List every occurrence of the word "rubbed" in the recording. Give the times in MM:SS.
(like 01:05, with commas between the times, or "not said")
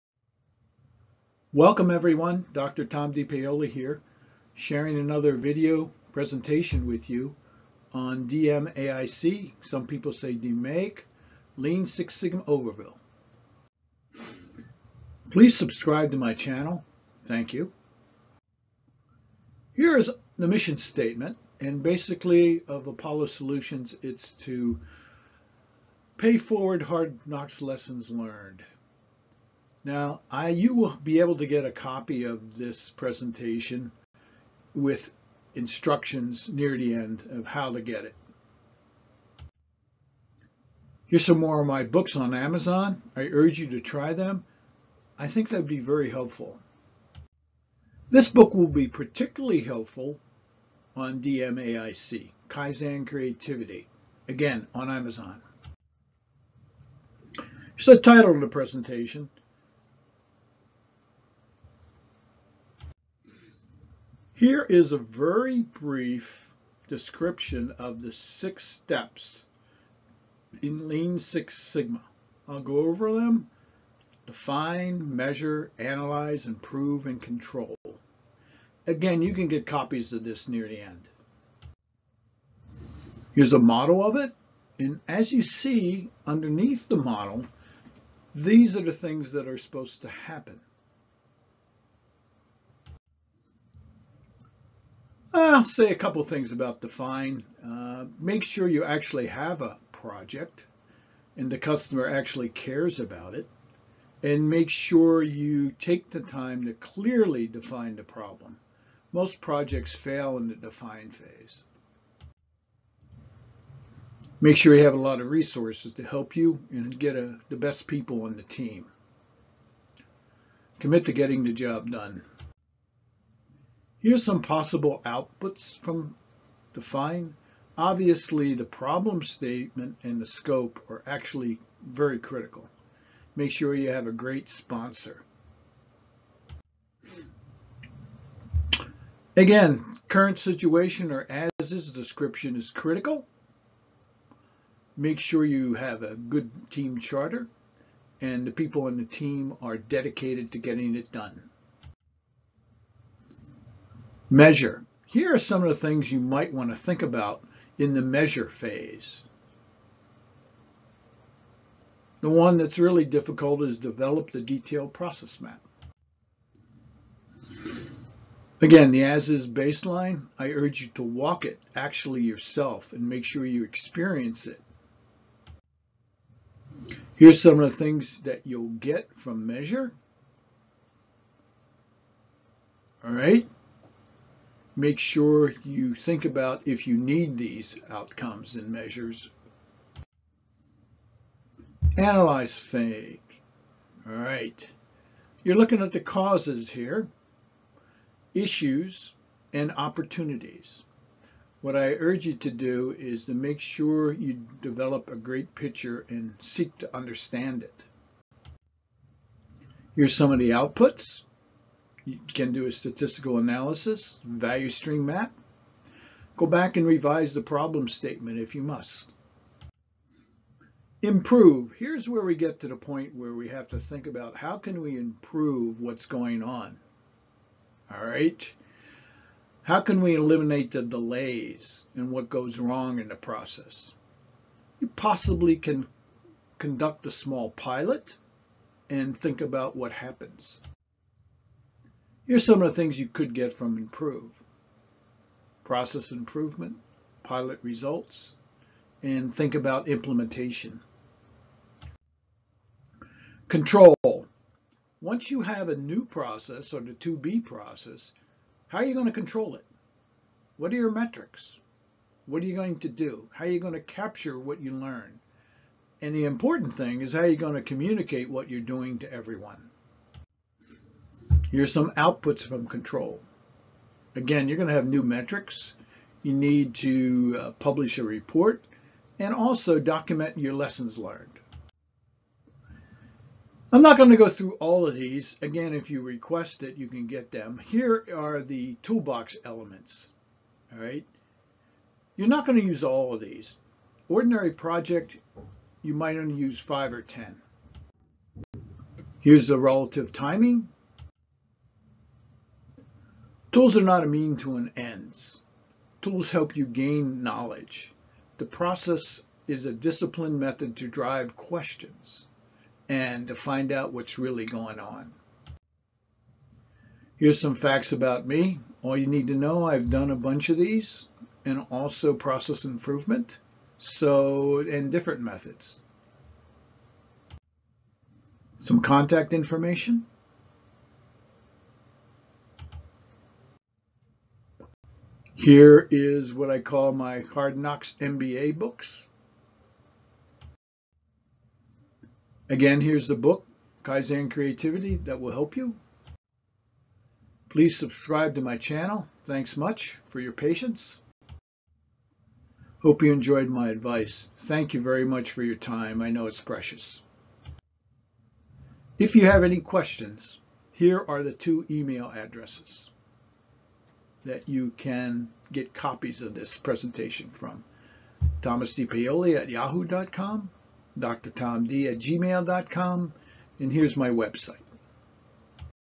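not said.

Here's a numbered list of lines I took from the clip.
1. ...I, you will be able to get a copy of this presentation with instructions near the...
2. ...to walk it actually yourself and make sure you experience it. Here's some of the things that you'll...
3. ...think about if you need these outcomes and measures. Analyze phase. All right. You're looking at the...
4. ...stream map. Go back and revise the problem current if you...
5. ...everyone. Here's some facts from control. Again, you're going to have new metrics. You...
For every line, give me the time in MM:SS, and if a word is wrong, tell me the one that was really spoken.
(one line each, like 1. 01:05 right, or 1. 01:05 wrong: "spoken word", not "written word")
1. 00:30 right
2. 02:50 right
3. 03:05 right
4. 03:34 wrong: "statement", not "current"
5. 04:29 wrong: "outputs", not "facts".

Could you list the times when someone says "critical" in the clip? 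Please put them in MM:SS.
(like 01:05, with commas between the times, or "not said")
02:12, 02:22.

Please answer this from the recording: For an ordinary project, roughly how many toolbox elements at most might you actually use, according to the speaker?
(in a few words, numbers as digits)
10.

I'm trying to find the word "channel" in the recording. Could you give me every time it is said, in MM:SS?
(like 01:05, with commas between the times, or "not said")
00:16, 05:48.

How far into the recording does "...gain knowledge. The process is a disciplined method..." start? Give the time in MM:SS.
05:06.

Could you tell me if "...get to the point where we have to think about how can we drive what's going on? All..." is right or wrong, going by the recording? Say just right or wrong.
wrong.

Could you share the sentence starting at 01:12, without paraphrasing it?
I'll go over them, define, measure, analyze, improve, and control.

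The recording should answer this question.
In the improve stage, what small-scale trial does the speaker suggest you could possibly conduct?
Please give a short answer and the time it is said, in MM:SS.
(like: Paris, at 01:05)
A small pilot, at 03:57.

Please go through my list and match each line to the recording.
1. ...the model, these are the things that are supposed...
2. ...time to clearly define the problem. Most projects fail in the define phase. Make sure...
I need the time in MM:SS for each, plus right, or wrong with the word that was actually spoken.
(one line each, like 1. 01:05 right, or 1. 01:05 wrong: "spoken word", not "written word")
1. 01:26 right
2. 01:46 right.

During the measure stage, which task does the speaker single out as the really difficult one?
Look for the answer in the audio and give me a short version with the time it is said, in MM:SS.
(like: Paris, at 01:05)
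Develop the detailed process map, at 02:43.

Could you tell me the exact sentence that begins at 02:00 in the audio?
Commit to getting the job done.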